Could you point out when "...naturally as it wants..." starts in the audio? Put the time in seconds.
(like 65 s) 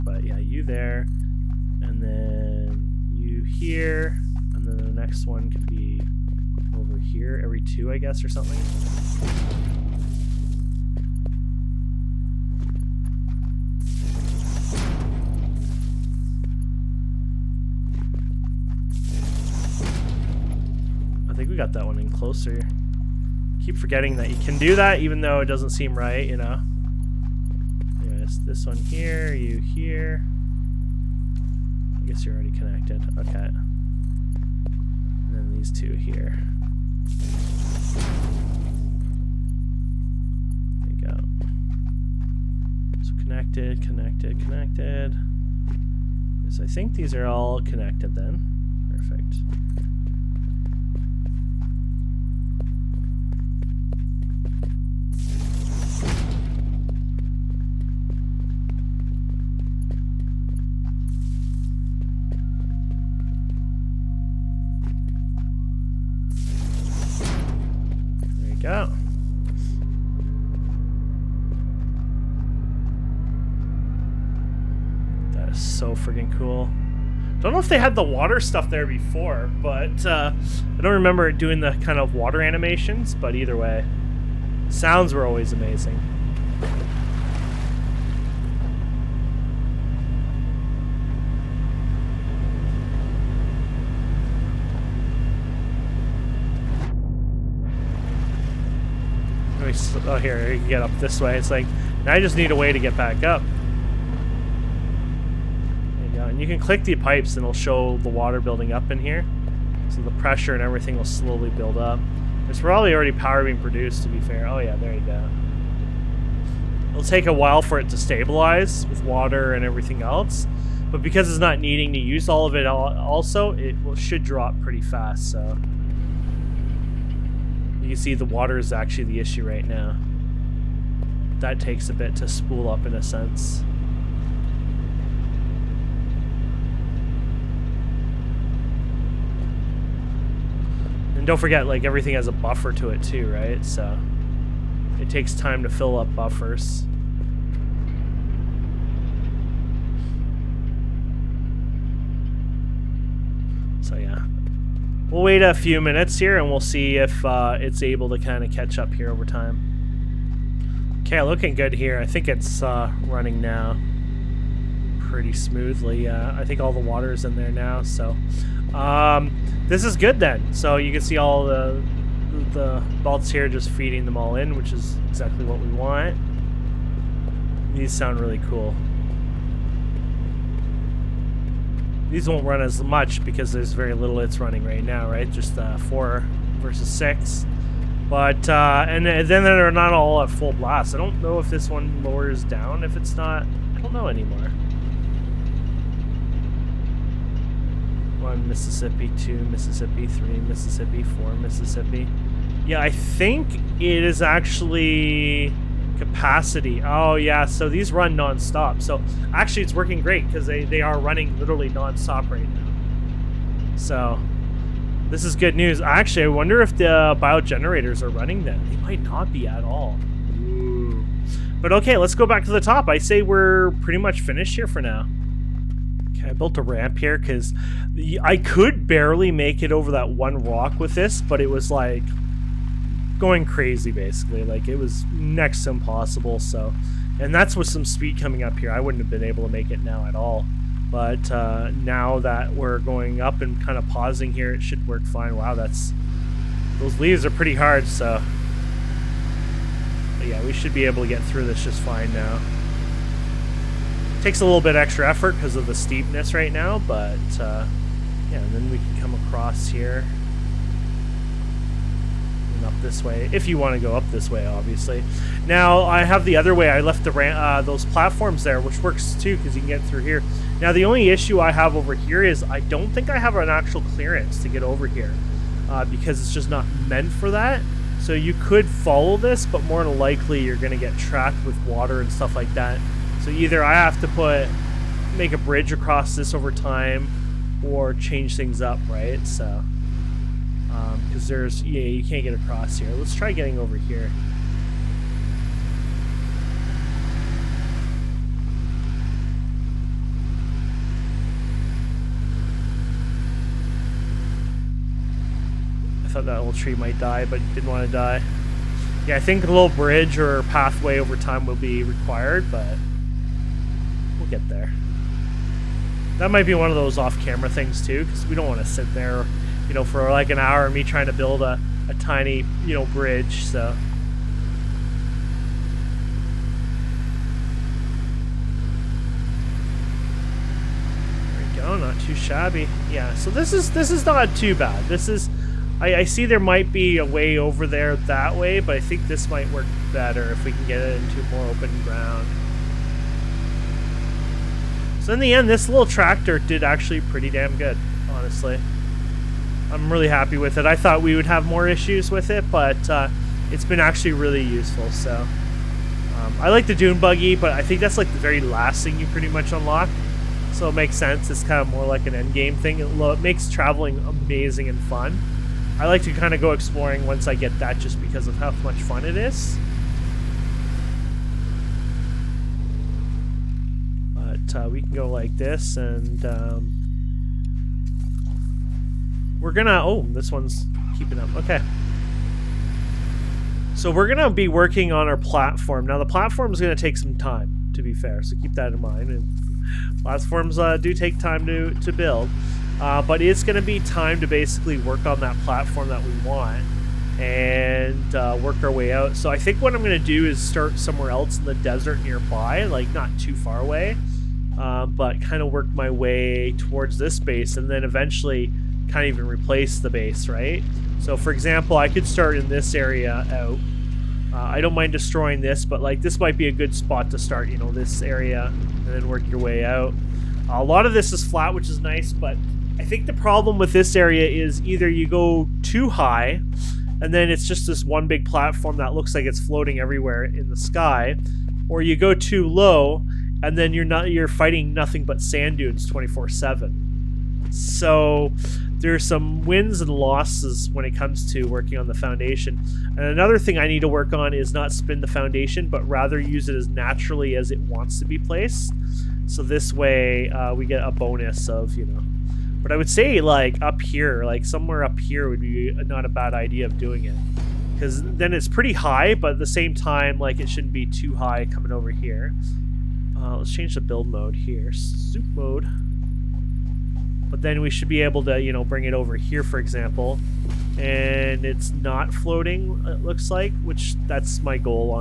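446 s.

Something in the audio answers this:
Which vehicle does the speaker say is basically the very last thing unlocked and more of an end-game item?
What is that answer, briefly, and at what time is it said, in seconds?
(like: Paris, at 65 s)
Dune buggy, at 356 s.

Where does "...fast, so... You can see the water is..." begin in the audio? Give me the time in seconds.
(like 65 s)
124 s.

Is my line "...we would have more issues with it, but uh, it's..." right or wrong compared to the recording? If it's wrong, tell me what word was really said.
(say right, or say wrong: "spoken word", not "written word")
right.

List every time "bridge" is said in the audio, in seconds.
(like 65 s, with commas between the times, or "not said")
285 s, 309 s, 322 s.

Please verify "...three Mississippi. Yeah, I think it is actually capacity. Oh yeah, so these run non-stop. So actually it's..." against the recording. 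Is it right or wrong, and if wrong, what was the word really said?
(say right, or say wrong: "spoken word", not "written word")
wrong: "four", not "three".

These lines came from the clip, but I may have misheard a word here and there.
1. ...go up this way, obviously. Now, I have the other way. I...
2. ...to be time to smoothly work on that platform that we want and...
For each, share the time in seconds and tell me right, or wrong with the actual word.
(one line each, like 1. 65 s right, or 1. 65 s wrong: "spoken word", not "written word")
1. 263 s right
2. 393 s wrong: "basically", not "smoothly".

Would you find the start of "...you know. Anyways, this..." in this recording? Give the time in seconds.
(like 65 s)
26 s.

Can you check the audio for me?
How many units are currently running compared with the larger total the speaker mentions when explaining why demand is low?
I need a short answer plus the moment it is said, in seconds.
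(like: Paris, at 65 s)
4 versus 6, at 185 s.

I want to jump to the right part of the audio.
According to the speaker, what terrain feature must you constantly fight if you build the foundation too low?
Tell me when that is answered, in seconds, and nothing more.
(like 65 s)
435 s.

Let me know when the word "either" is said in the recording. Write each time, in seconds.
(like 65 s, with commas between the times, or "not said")
83 s, 283 s, 424 s.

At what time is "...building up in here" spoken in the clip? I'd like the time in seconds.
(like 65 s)
108 s.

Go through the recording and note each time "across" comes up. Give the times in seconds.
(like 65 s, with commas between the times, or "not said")
259 s, 285 s, 292 s.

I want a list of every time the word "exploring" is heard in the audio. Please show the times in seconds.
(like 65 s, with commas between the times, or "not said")
366 s.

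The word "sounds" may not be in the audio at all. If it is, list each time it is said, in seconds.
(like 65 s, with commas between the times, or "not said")
84 s, 177 s.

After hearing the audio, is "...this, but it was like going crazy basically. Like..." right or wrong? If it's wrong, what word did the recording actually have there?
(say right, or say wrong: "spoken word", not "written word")
right.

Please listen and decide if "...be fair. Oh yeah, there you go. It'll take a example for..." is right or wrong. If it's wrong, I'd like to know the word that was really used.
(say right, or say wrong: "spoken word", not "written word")
wrong: "while", not "example".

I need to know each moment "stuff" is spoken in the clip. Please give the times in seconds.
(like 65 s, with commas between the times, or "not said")
78 s, 282 s.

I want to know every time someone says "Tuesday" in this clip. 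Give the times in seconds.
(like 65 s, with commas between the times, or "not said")
not said.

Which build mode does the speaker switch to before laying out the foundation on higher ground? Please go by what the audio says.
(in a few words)
Zoop mode.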